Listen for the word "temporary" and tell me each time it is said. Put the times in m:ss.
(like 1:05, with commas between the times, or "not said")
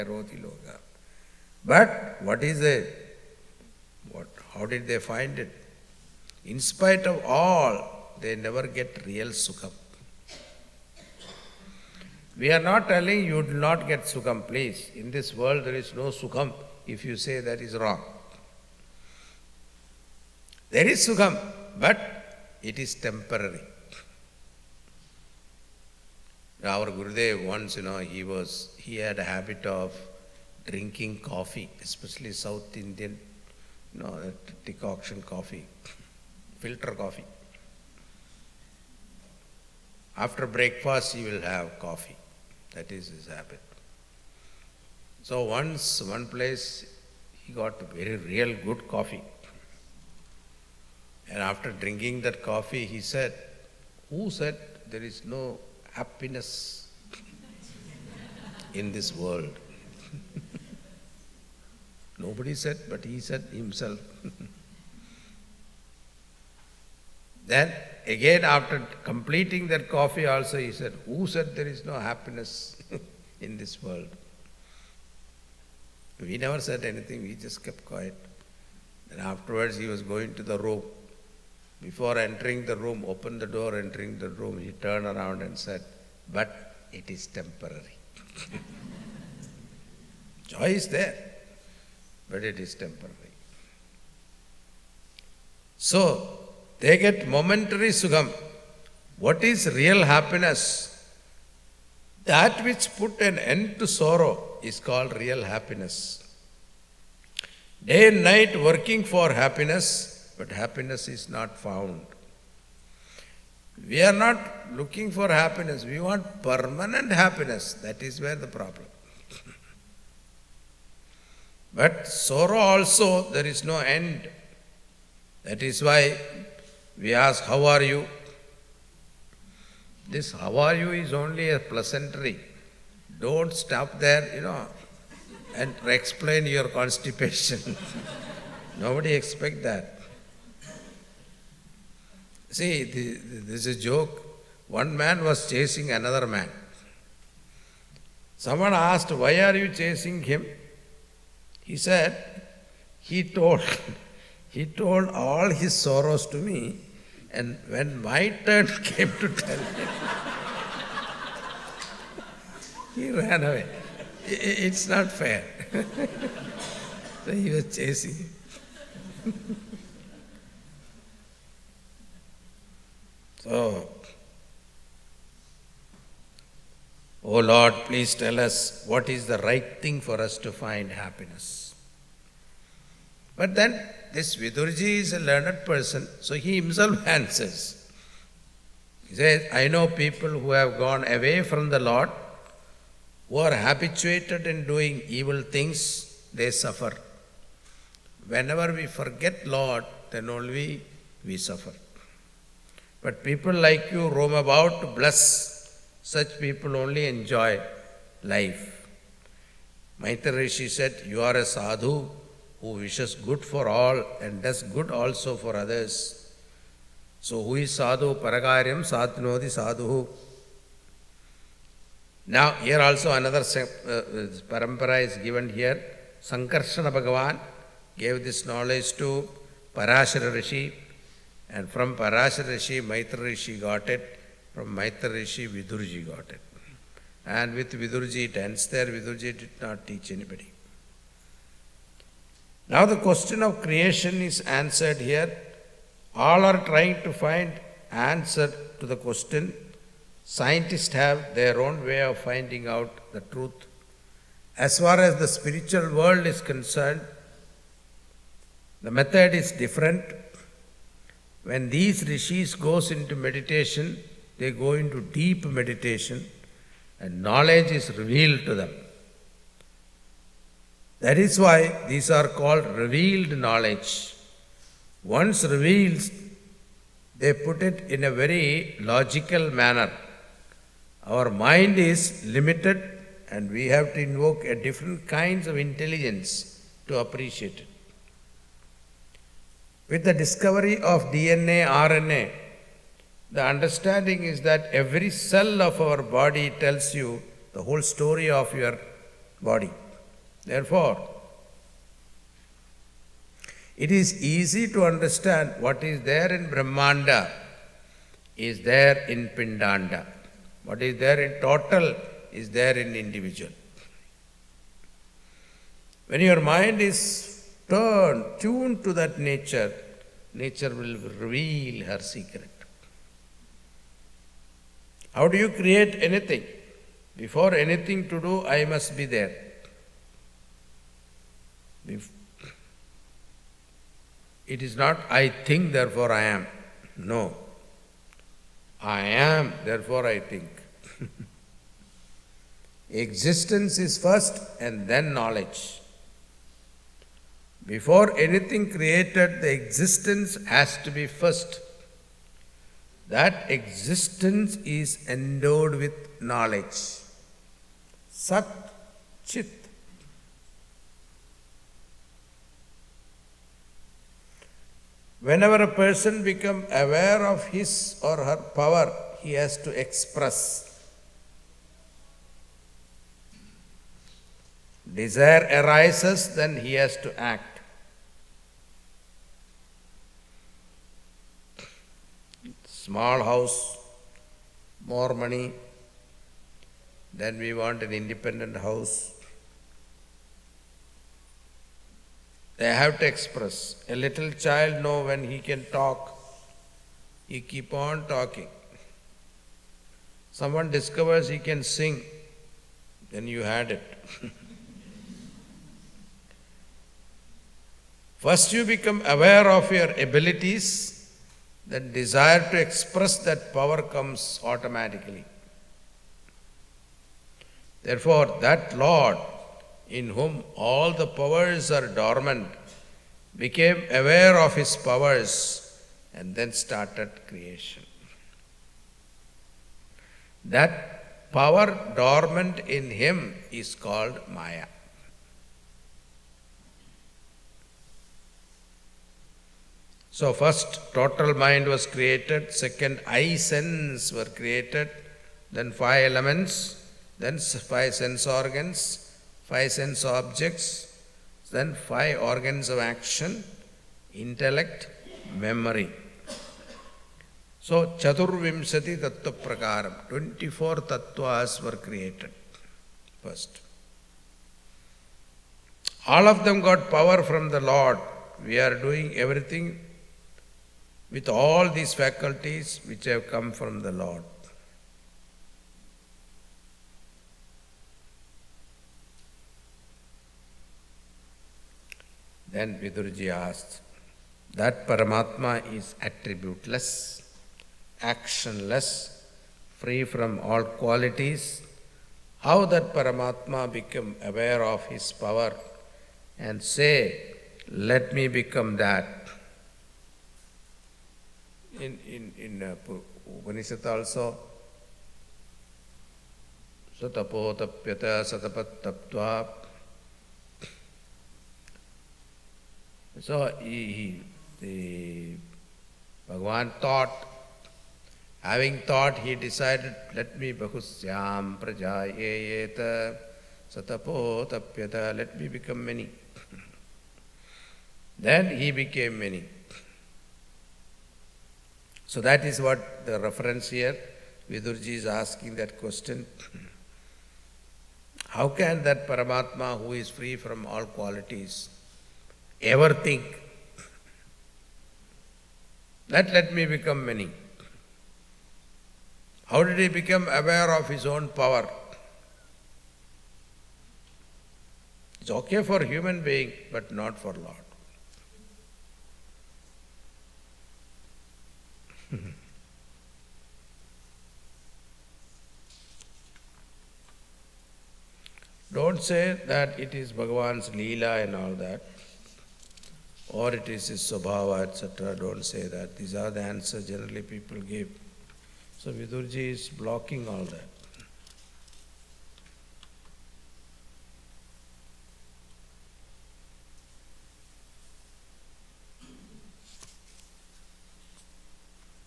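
0:22, 1:27, 1:32.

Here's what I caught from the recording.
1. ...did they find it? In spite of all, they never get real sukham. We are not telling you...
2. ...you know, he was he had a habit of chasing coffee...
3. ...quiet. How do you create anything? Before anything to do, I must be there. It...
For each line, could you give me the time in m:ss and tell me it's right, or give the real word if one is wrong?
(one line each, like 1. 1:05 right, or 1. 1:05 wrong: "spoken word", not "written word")
1. 0:04 right
2. 0:27 wrong: "drinking", not "chasing"
3. 5:21 wrong: "secret", not "quiet".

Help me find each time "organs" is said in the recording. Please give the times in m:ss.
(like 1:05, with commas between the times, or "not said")
7:28, 7:32.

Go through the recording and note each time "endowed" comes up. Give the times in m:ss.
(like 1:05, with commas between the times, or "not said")
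5:55.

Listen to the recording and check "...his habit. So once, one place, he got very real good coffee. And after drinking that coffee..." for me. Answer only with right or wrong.
right.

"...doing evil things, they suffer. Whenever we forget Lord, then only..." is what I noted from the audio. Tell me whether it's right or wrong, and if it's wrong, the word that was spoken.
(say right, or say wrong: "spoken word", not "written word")
right.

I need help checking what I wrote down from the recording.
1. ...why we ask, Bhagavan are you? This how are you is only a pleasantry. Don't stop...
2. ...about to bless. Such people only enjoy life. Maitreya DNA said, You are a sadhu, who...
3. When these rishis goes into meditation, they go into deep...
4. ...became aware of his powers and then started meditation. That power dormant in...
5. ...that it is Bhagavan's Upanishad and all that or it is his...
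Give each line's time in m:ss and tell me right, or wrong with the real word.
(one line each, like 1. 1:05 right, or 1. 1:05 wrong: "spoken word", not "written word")
1. 2:05 wrong: "How", not "Bhagavan"
2. 3:24 wrong: "Rishi", not "DNA"
3. 4:21 right
4. 7:03 wrong: "creation", not "meditation"
5. 9:29 wrong: "Leela", not "Upanishad".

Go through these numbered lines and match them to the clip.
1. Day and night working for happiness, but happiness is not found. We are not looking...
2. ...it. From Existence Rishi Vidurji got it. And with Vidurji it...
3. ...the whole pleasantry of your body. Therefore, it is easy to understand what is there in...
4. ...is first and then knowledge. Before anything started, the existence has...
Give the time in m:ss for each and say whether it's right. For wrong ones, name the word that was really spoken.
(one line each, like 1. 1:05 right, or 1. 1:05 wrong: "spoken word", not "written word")
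1. 1:47 right
2. 3:53 wrong: "Maitreya", not "Existence"
3. 4:57 wrong: "story", not "pleasantry"
4. 5:43 wrong: "created", not "started".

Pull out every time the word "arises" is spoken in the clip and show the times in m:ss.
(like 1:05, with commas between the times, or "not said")
6:15.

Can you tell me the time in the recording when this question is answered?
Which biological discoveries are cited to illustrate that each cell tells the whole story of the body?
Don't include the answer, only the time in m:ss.
4:51.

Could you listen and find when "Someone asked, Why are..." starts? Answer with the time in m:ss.
2:28.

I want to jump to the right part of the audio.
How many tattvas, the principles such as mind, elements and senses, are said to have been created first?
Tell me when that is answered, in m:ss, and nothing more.
7:40.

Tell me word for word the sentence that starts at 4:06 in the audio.
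All are trying to find answer to the question.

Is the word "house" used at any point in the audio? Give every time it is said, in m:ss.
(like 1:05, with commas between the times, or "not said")
6:23, 6:28.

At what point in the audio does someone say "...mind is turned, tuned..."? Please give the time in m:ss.
5:16.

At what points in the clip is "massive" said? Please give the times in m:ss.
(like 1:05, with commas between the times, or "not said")
not said.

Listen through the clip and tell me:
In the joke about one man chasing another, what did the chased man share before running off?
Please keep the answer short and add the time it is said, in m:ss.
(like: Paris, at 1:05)
His sorrows, at 2:35.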